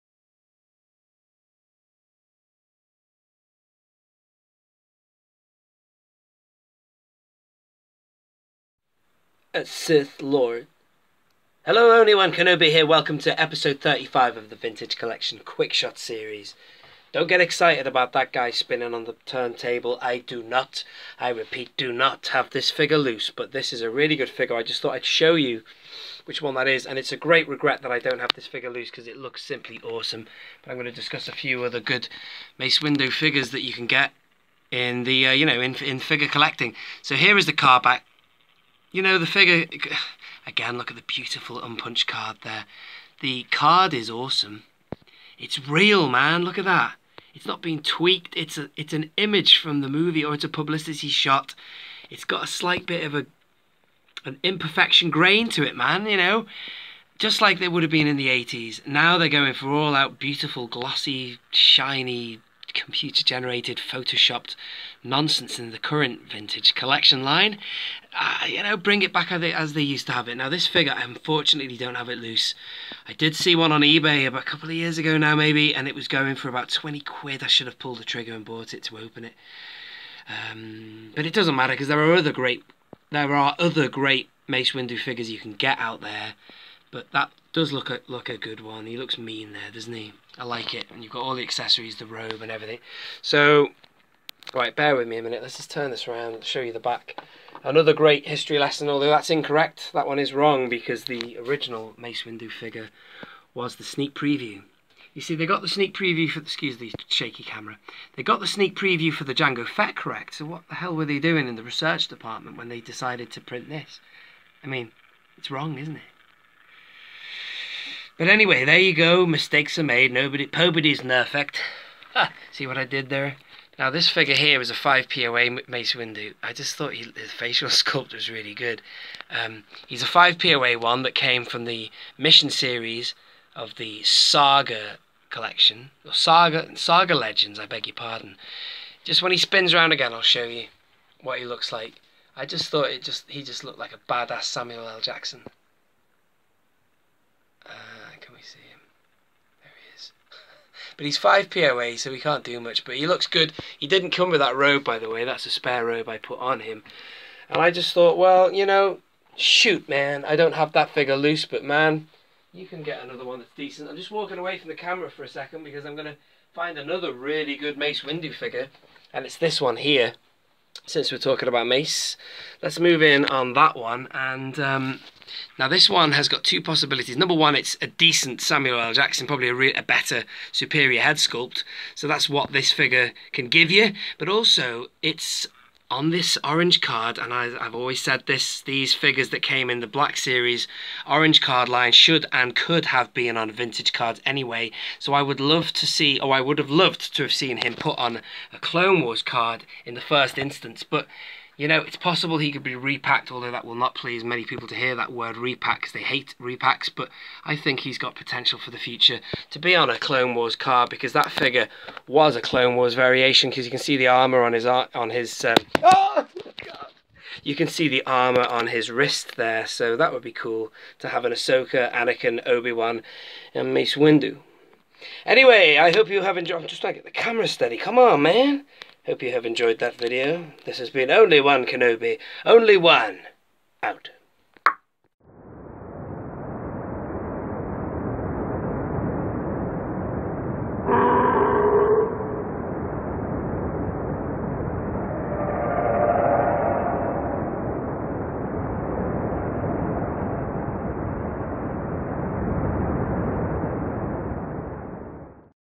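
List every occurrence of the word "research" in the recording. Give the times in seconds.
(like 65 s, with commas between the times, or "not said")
111 s.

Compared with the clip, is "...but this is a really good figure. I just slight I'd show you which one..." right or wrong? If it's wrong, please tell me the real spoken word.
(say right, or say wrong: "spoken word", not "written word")
wrong: "thought", not "slight".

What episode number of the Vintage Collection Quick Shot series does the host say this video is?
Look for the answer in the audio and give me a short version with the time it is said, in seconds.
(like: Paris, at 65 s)
35, at 13 s.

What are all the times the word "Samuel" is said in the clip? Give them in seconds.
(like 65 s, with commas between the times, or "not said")
144 s, 178 s.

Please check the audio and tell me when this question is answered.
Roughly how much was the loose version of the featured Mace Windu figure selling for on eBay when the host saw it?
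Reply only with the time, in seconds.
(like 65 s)
76 s.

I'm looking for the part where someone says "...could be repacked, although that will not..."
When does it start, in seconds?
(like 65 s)
202 s.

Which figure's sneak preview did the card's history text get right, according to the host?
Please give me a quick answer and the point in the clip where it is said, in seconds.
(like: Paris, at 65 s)
Jango Fett, at 109 s.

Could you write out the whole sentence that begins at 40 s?
Again, look at the beautiful unpunched card there.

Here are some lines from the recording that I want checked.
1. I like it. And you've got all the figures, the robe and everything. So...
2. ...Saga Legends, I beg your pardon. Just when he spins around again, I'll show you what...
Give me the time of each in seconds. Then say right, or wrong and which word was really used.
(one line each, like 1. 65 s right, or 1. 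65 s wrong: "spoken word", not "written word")
1. 90 s wrong: "accessories", not "figures"
2. 136 s right.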